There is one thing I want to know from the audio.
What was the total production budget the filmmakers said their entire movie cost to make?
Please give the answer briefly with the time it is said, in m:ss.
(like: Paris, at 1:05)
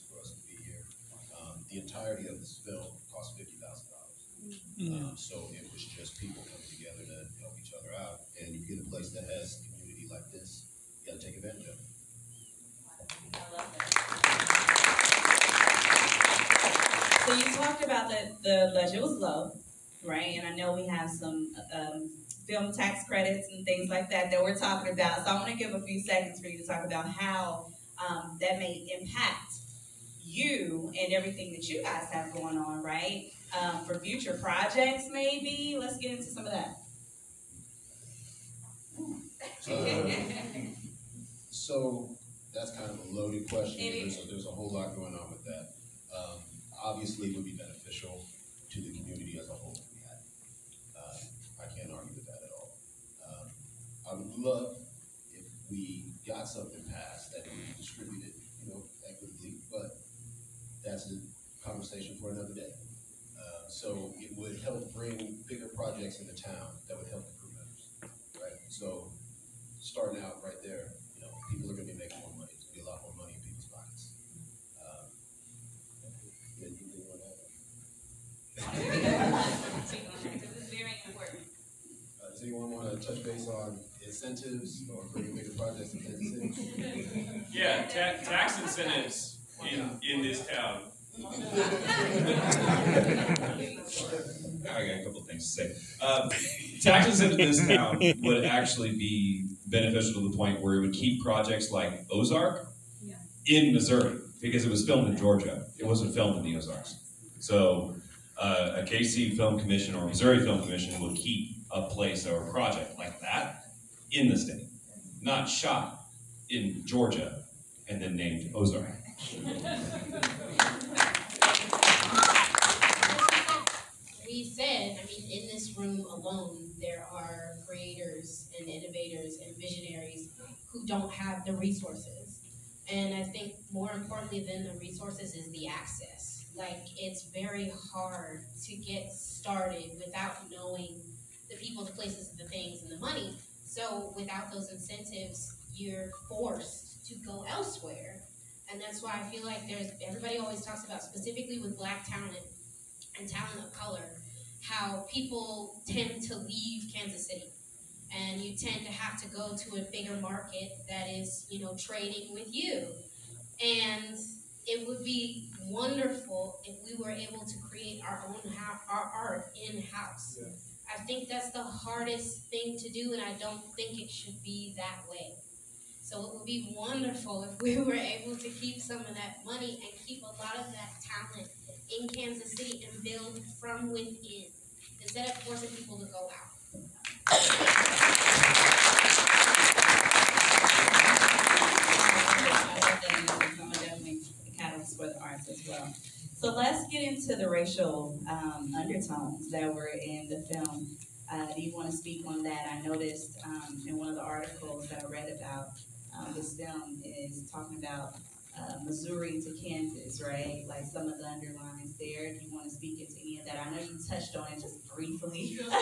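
$50,000, at 0:03.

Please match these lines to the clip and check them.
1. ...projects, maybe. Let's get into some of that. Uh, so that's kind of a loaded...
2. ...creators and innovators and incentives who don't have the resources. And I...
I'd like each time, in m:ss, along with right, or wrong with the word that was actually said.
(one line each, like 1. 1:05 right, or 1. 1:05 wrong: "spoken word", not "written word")
1. 0:34 right
2. 2:07 wrong: "visionaries", not "incentives".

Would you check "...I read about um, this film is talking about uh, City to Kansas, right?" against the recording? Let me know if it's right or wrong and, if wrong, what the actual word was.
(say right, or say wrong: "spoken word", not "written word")
wrong: "Missouri", not "City".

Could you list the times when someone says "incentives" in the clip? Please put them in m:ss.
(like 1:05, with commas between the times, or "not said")
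1:24, 1:28, 2:24.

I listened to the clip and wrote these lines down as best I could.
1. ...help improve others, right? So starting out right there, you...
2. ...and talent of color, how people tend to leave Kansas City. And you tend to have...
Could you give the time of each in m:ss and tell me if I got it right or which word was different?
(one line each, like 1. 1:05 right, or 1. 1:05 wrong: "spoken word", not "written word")
1. 1:07 right
2. 2:33 right.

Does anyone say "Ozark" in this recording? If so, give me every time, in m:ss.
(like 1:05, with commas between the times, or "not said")
1:42, 1:46, 1:58.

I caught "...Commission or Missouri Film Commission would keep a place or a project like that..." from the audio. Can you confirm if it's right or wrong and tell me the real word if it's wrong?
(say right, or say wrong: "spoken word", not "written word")
right.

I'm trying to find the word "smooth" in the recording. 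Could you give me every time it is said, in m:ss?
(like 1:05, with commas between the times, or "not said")
not said.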